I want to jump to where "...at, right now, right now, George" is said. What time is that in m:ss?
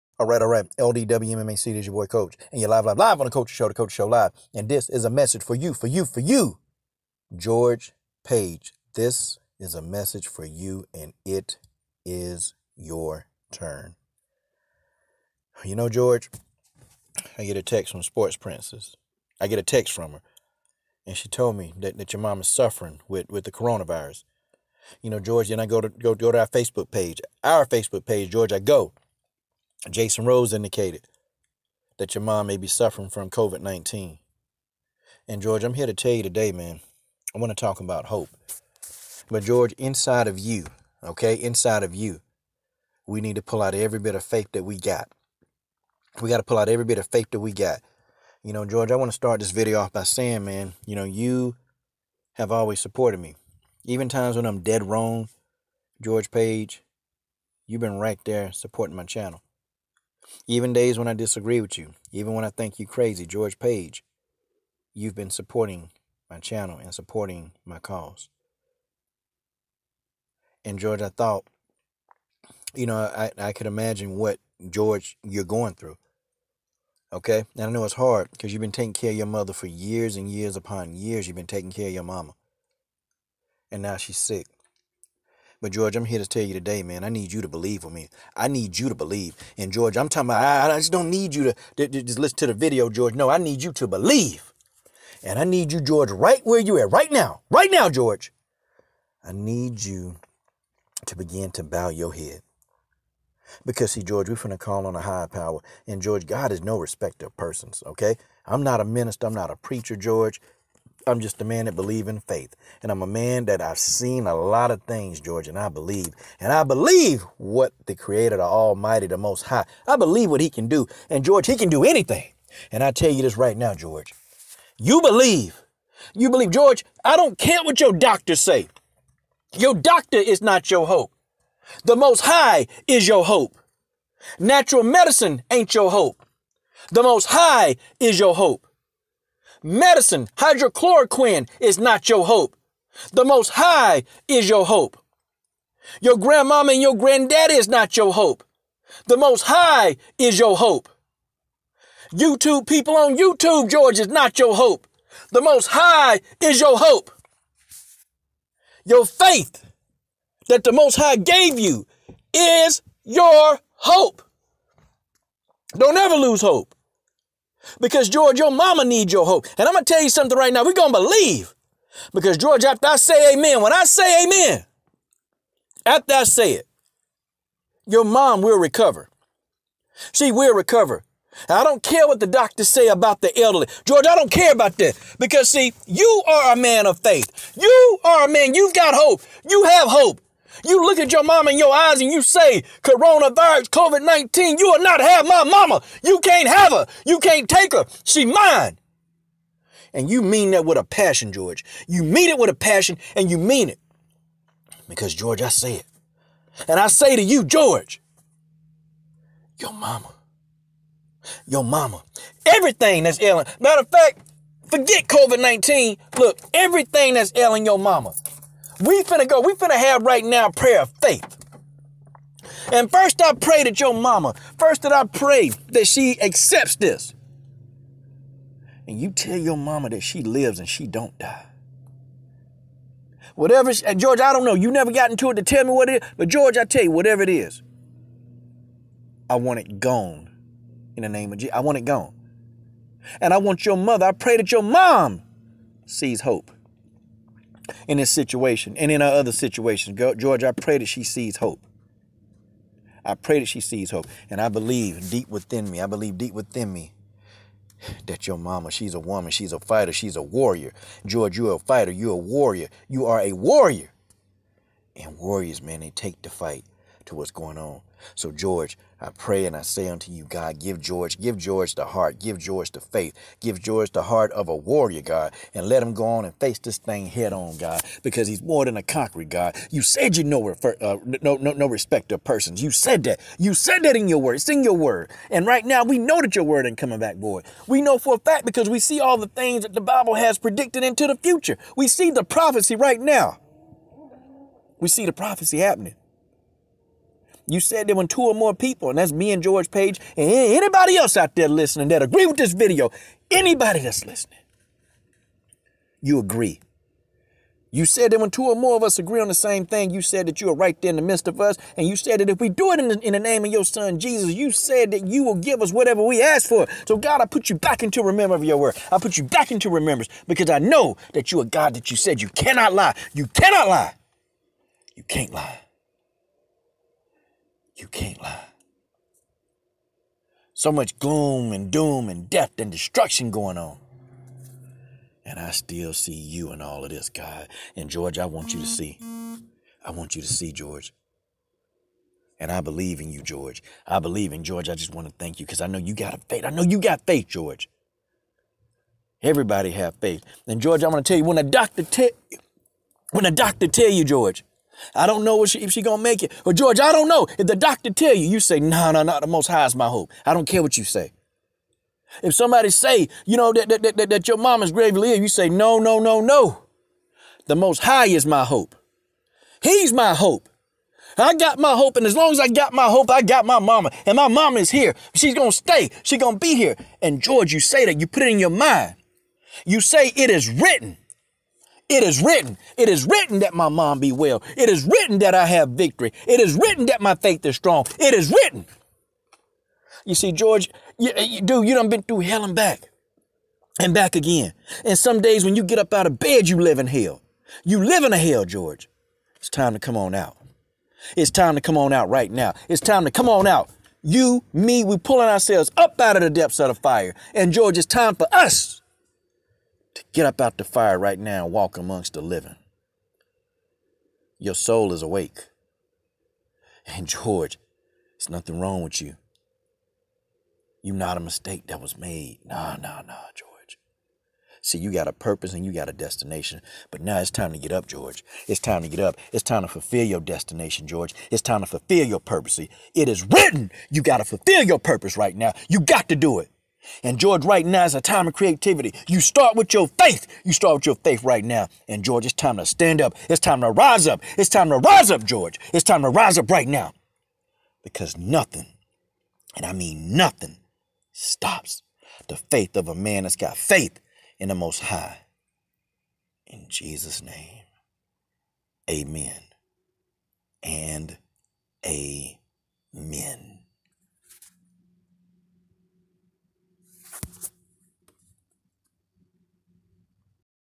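1:36.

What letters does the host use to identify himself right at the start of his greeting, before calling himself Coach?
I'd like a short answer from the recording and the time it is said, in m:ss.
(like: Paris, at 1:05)
LDW MMA, at 0:00.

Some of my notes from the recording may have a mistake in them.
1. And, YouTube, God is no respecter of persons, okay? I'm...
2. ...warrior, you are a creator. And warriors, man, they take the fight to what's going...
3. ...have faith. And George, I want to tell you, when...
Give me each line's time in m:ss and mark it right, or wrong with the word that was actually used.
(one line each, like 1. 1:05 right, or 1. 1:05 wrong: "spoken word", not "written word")
1. 1:45 wrong: "George", not "YouTube"
2. 4:22 wrong: "warrior", not "creator"
3. 5:49 right.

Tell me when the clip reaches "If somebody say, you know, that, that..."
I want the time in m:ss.
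6:02.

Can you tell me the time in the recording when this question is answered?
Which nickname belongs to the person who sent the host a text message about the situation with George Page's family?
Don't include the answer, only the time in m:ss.
0:18.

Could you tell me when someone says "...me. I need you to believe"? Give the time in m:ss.
1:27.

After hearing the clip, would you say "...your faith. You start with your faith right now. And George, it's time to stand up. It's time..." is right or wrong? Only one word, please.
right.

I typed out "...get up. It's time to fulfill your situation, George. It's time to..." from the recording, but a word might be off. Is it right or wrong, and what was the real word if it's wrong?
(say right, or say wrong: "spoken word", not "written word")
wrong: "destination", not "situation".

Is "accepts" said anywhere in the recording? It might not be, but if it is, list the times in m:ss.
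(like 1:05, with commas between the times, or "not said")
3:46.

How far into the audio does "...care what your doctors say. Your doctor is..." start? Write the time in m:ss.
2:07.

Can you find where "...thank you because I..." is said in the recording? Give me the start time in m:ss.
5:45.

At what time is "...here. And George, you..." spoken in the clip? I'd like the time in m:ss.
6:16.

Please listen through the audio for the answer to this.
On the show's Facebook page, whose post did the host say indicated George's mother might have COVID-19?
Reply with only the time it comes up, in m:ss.
0:29.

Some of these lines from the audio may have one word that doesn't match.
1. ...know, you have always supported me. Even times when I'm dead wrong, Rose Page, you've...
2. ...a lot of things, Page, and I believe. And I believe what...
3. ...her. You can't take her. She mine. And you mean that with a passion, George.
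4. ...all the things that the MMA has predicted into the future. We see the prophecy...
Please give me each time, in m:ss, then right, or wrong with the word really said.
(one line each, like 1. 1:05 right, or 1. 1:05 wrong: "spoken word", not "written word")
1. 0:50 wrong: "George", not "Rose"
2. 1:54 wrong: "George", not "Page"
3. 3:16 right
4. 4:48 wrong: "Bible", not "MMA".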